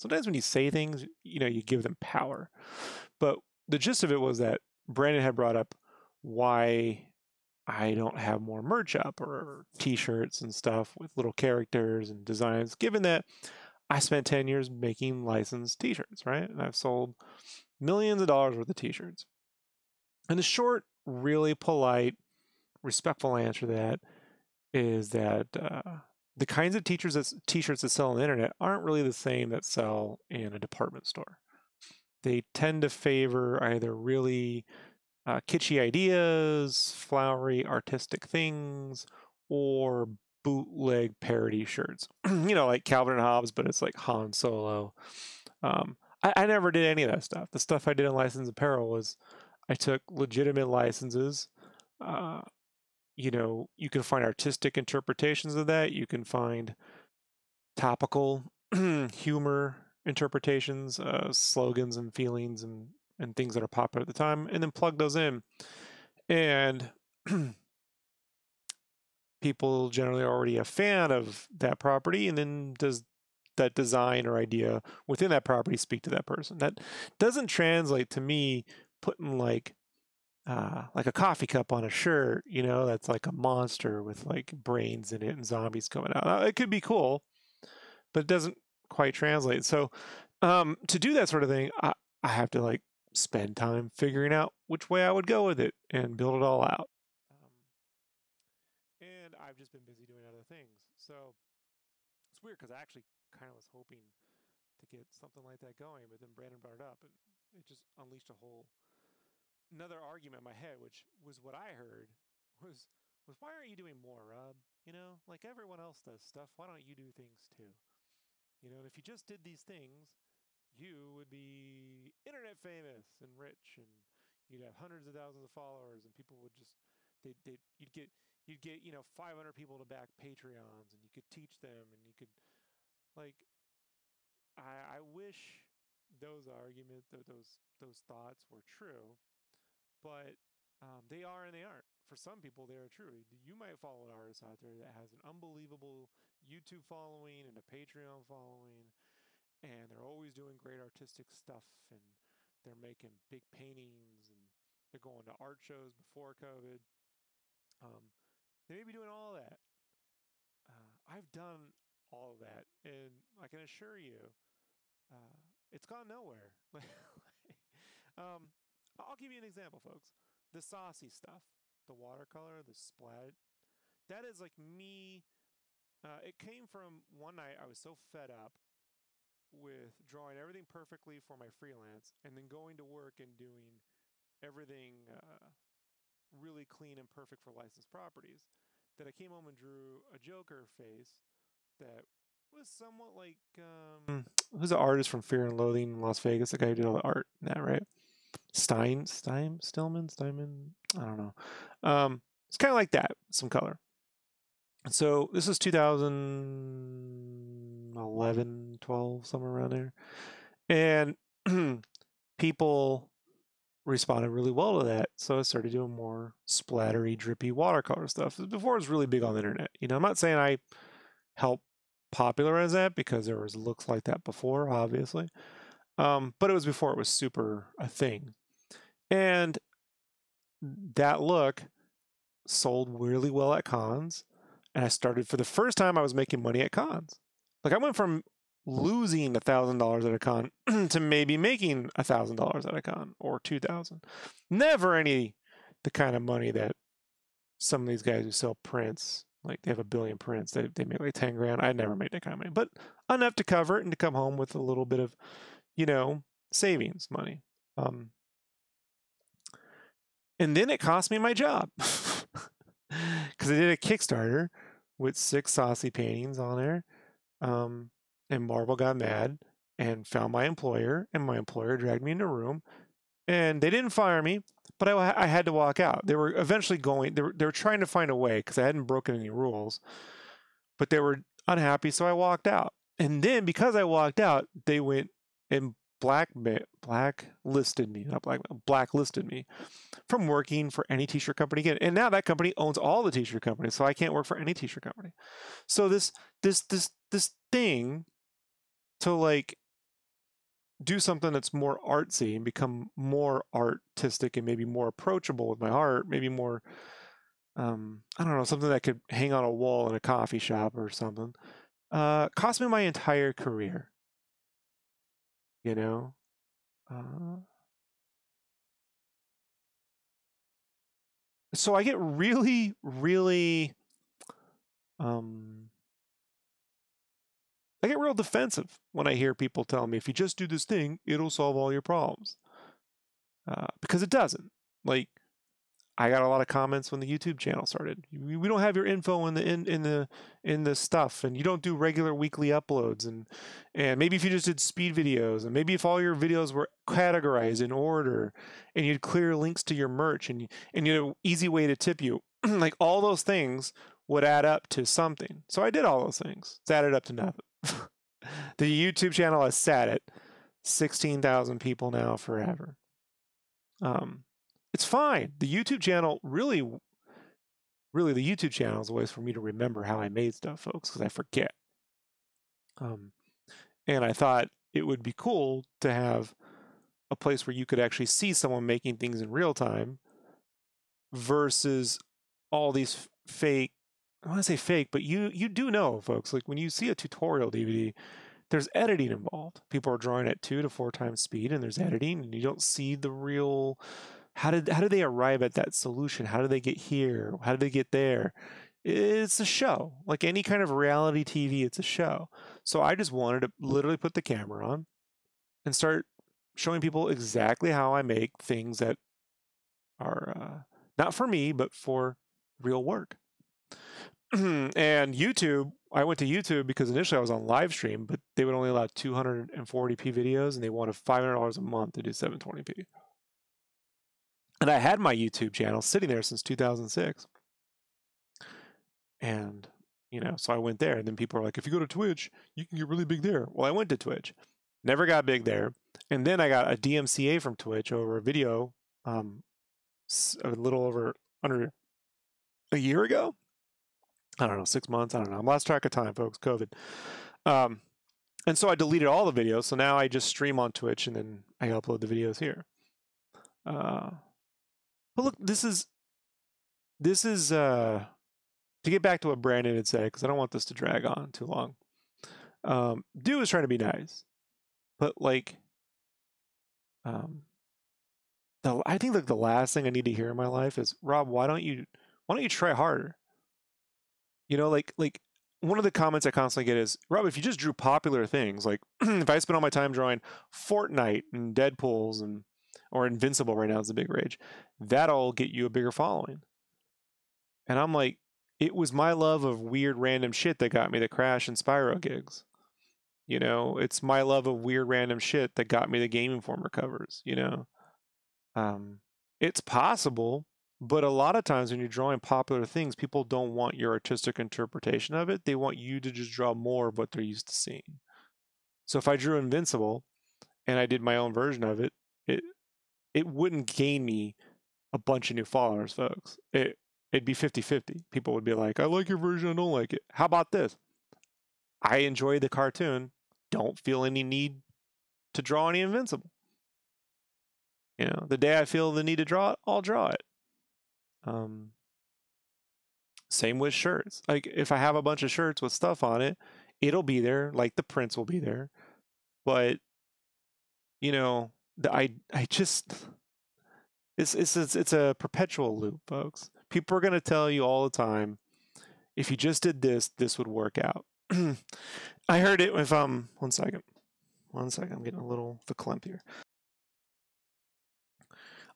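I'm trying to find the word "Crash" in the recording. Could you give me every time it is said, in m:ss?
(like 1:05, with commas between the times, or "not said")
8:11.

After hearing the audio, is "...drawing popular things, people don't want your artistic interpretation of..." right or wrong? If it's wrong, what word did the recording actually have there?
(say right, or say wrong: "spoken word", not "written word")
right.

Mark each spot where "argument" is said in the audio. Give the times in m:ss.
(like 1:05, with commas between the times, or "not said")
1:49, 2:16.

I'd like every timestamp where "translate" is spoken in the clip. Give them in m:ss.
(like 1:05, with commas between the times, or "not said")
1:17, 1:29.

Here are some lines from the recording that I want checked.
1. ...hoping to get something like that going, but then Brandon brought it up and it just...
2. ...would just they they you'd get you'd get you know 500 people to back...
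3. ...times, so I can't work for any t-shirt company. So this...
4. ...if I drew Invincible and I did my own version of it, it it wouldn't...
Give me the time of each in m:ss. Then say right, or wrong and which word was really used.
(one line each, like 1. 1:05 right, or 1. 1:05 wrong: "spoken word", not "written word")
1. 1:43 right
2. 2:06 right
3. 4:53 wrong: "companies", not "times"
4. 8:28 right.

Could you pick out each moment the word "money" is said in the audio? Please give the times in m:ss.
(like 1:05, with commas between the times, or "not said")
3:56, 4:06, 4:12, 4:17.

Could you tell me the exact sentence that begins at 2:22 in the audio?
For some people, they are true.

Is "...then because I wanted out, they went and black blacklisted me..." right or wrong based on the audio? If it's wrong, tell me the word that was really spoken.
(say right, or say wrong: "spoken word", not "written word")
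wrong: "walked", not "wanted".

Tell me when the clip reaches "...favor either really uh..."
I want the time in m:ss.
0:32.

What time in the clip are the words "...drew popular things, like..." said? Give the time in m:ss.
7:57.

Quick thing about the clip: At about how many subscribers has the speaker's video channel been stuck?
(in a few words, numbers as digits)
16,000.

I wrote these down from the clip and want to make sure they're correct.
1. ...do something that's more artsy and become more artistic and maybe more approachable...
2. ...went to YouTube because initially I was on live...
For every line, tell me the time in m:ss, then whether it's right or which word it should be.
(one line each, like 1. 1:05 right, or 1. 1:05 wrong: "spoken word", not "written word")
1. 5:00 right
2. 6:56 right.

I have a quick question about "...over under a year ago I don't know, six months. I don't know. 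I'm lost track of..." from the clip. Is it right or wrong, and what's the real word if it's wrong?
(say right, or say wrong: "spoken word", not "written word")
right.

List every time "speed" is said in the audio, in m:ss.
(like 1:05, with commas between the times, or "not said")
5:44, 6:31.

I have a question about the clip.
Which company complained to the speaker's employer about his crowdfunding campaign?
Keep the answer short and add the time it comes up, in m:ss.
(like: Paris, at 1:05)
Marvel, at 4:28.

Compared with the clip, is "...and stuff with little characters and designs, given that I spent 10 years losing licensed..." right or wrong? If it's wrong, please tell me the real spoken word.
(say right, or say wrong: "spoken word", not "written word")
wrong: "making", not "losing".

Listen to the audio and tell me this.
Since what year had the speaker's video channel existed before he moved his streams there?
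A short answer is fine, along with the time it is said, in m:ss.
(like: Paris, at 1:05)
2006, at 7:06.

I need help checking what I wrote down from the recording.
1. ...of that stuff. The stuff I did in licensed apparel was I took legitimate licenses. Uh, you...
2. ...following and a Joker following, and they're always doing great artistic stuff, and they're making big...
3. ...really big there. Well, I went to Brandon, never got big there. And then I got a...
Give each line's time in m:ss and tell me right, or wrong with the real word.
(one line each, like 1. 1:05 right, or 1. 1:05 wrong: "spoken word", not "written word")
1. 0:47 right
2. 2:26 wrong: "Patreon", not "Joker"
3. 7:12 wrong: "Twitch", not "Brandon".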